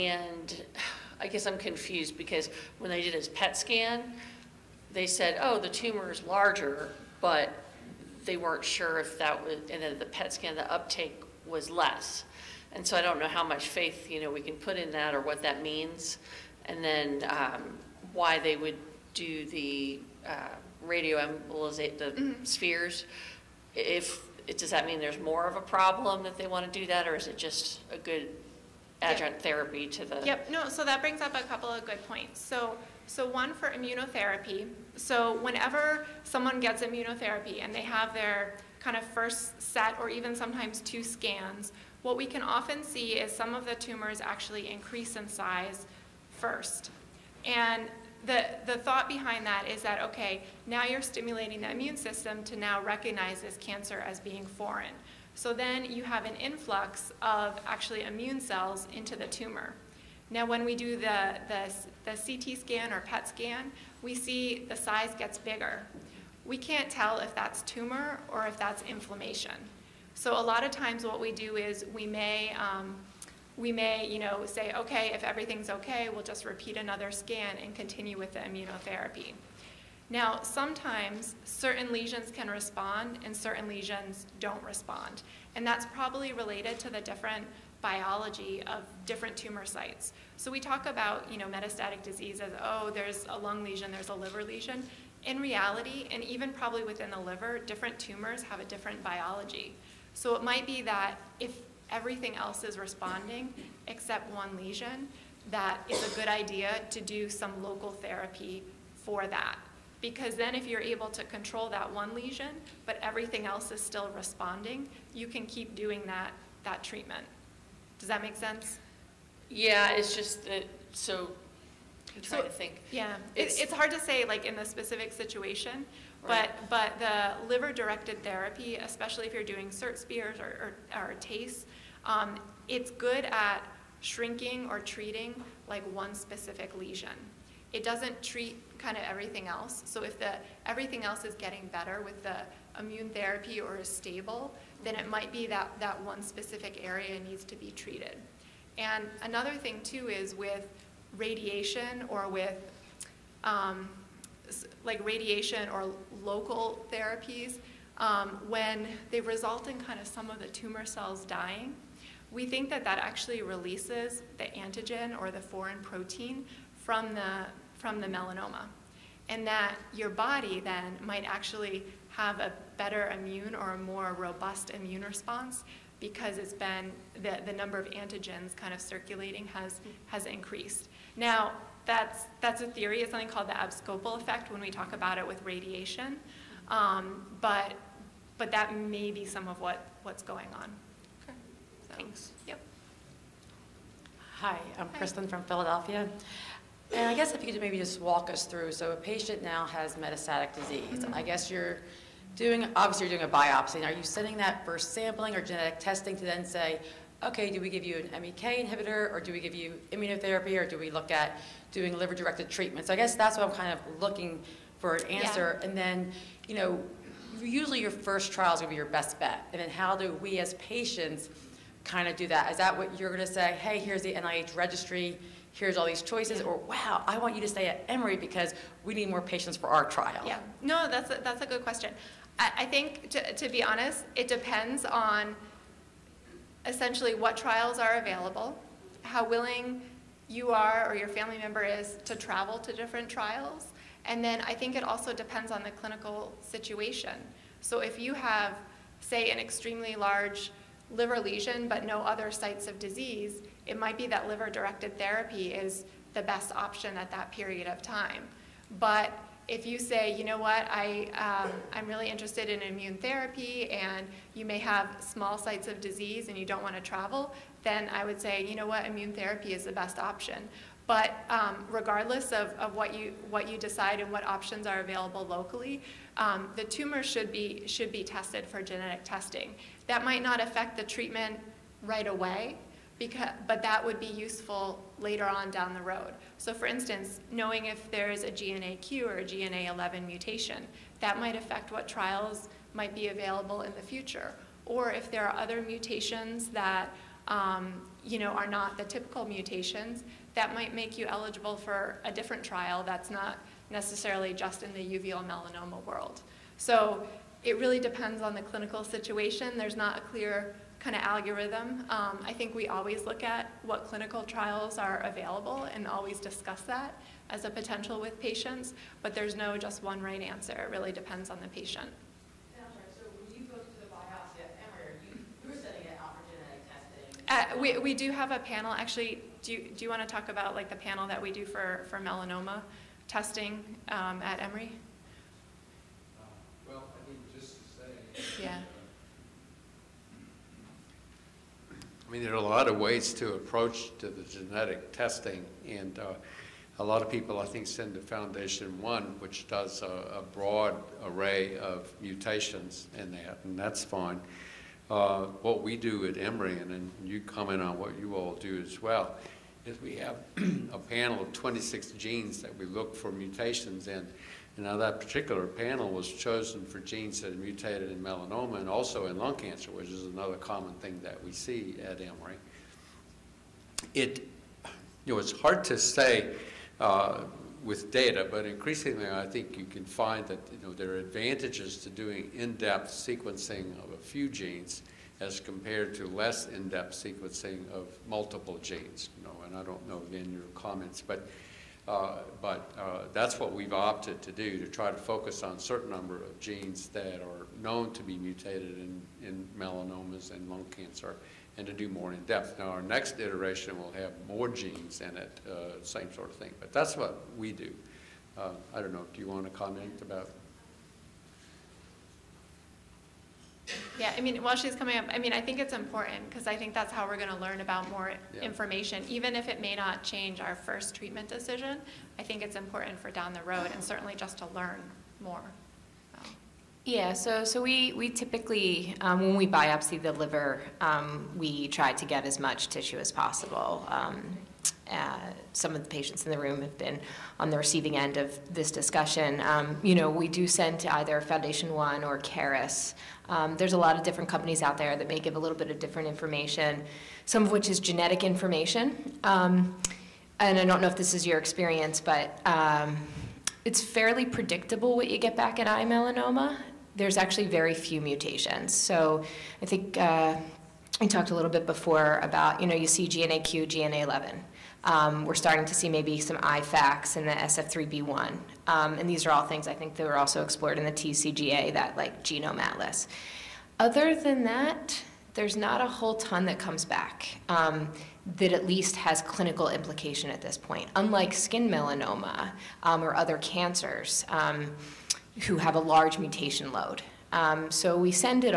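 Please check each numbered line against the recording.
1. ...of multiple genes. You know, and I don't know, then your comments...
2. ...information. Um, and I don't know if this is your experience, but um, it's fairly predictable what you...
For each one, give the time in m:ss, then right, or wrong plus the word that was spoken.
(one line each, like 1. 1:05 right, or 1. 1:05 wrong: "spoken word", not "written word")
1. 6:27 right
2. 7:28 right.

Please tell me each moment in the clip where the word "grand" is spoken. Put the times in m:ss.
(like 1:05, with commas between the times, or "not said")
not said.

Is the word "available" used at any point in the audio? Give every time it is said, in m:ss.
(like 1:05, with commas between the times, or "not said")
3:57, 4:34, 4:53, 5:14.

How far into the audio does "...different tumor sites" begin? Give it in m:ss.
1:29.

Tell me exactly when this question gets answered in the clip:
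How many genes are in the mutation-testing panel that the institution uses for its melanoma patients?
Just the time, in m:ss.
6:01.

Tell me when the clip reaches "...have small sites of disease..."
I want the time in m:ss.
4:24.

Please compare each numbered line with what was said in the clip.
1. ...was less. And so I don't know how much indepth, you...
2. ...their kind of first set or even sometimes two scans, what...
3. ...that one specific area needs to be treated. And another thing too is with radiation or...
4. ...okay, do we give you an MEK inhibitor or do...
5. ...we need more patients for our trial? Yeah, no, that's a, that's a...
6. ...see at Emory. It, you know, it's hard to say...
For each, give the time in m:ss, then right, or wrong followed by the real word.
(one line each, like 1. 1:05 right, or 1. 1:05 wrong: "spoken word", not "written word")
1. 0:11 wrong: "faith", not "indepth"
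2. 0:38 right
3. 2:25 right
4. 3:27 right
5. 3:48 right
6. 6:11 right.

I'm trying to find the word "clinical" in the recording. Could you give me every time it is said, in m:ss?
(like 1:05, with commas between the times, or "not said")
4:05, 5:08, 5:13, 7:59.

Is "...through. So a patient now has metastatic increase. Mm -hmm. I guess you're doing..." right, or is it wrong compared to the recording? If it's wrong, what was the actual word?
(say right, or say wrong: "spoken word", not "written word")
wrong: "disease", not "increase".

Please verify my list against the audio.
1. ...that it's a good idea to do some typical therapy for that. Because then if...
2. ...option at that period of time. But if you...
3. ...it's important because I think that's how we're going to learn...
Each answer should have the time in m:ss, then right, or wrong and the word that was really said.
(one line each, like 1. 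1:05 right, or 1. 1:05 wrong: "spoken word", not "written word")
1. 1:45 wrong: "local", not "typical"
2. 4:16 right
3. 6:55 right.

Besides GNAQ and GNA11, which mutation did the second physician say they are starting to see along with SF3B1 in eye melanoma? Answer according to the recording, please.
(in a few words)
EIF1AX.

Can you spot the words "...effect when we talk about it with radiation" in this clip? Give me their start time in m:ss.
3:04.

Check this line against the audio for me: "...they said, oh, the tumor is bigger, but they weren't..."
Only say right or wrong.
wrong.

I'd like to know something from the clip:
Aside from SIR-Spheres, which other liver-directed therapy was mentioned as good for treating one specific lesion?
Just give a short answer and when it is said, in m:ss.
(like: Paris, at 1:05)
TACE, at 2:11.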